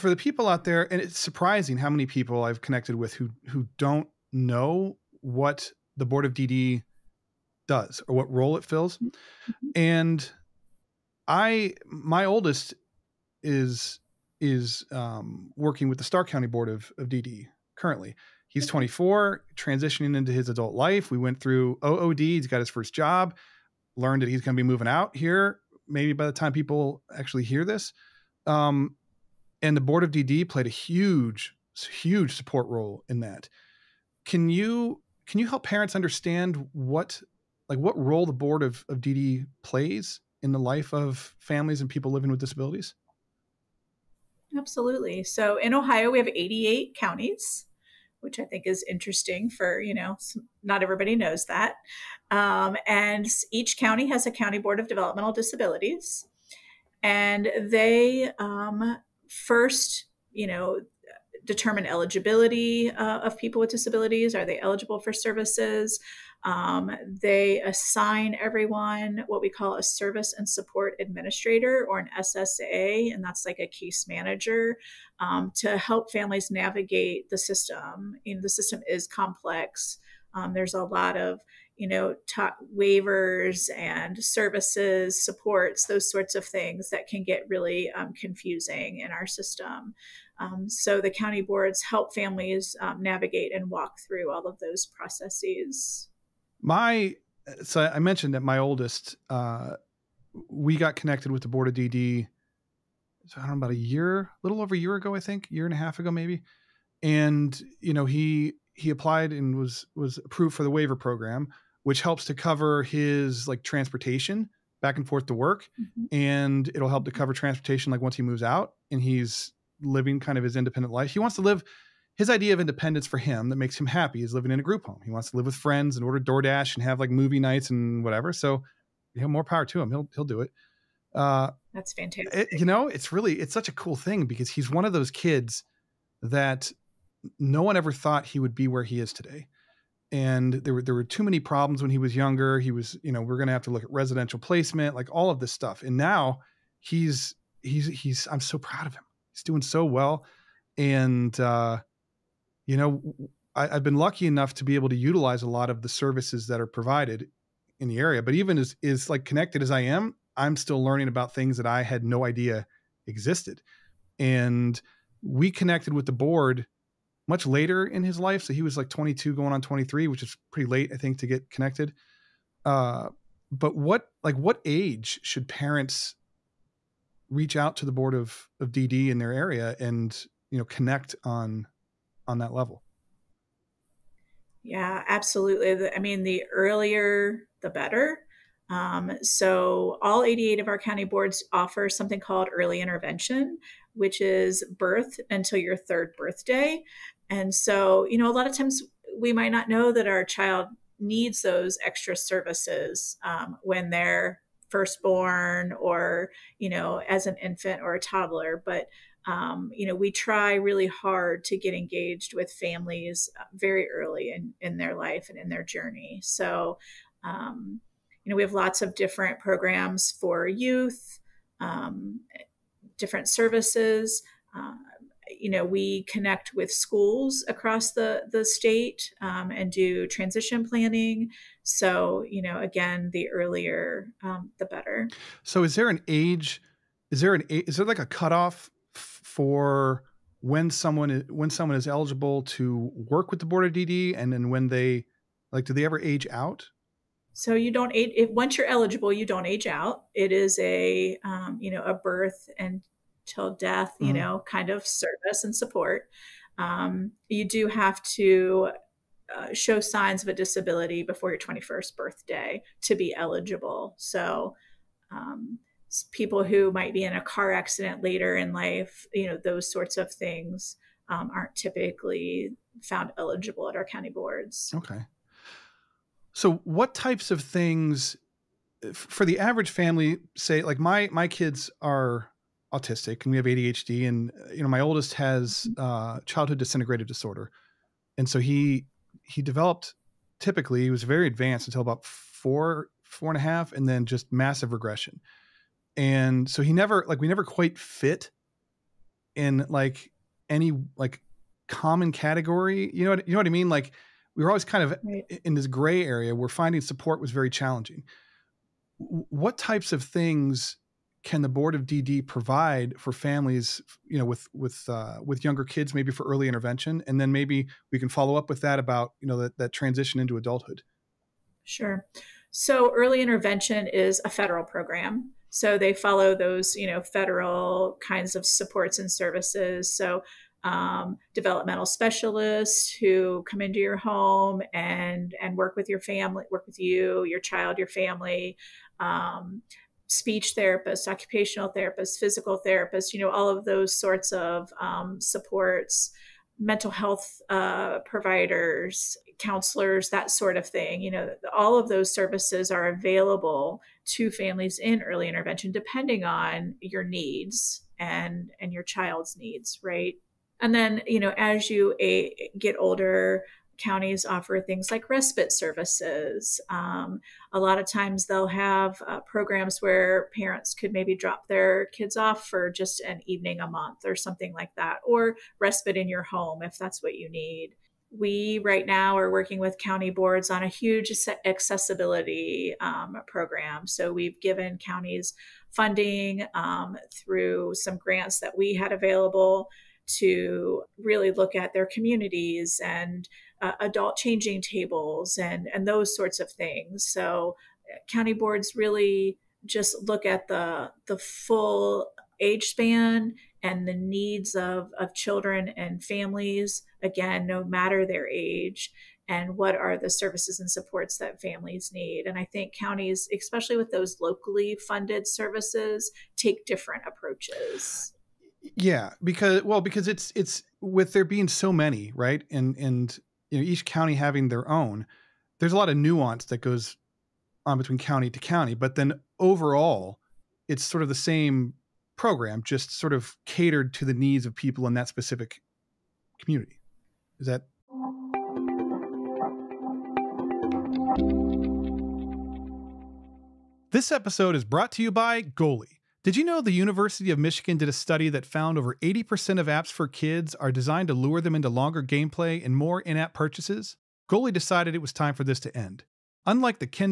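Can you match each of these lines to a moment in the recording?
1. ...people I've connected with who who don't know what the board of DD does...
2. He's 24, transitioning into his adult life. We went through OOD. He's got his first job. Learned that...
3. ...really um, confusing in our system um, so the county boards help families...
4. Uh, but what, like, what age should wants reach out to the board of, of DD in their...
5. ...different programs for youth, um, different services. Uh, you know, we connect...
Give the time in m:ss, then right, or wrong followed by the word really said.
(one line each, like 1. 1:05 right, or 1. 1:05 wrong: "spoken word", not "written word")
1. 0:02 right
2. 0:18 right
3. 1:27 right
4. 2:52 wrong: "parents", not "wants"
5. 3:38 right.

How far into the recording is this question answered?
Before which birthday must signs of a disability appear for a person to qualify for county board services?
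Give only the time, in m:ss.
4:21.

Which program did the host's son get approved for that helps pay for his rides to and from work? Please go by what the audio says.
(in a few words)
Waiver program.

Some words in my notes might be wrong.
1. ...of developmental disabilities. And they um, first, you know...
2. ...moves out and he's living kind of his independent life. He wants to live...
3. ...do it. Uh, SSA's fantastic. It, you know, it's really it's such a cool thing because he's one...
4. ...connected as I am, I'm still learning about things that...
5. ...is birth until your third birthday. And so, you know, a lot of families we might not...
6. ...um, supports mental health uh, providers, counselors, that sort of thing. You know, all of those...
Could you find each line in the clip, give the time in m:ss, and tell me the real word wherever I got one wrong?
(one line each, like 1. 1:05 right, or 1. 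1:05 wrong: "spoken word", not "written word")
1. 0:54 right
2. 1:58 right
3. 2:10 wrong: "That", not "SSA"
4. 2:39 right
5. 3:14 wrong: "times", not "families"
6. 5:44 right.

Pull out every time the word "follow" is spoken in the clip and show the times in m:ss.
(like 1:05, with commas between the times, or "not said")
5:18, 5:25.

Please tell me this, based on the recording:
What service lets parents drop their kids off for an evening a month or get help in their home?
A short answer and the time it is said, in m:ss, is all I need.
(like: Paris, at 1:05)
Respite services, at 6:05.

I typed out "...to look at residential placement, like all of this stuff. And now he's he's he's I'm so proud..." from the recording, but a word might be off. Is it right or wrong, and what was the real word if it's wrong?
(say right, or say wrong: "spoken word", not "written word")
right.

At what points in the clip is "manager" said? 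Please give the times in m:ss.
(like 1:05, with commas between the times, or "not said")
1:14.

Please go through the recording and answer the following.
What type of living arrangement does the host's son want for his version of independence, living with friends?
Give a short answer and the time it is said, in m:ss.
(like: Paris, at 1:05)
Group home, at 2:04.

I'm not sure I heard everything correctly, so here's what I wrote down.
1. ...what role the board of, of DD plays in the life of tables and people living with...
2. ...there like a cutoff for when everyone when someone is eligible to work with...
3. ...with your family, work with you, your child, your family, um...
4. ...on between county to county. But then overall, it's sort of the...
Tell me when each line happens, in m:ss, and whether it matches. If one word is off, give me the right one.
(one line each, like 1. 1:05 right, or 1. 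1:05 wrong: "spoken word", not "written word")
1. 0:37 wrong: "families", not "tables"
2. 3:57 wrong: "someone", not "everyone"
3. 5:35 right
4. 7:07 right.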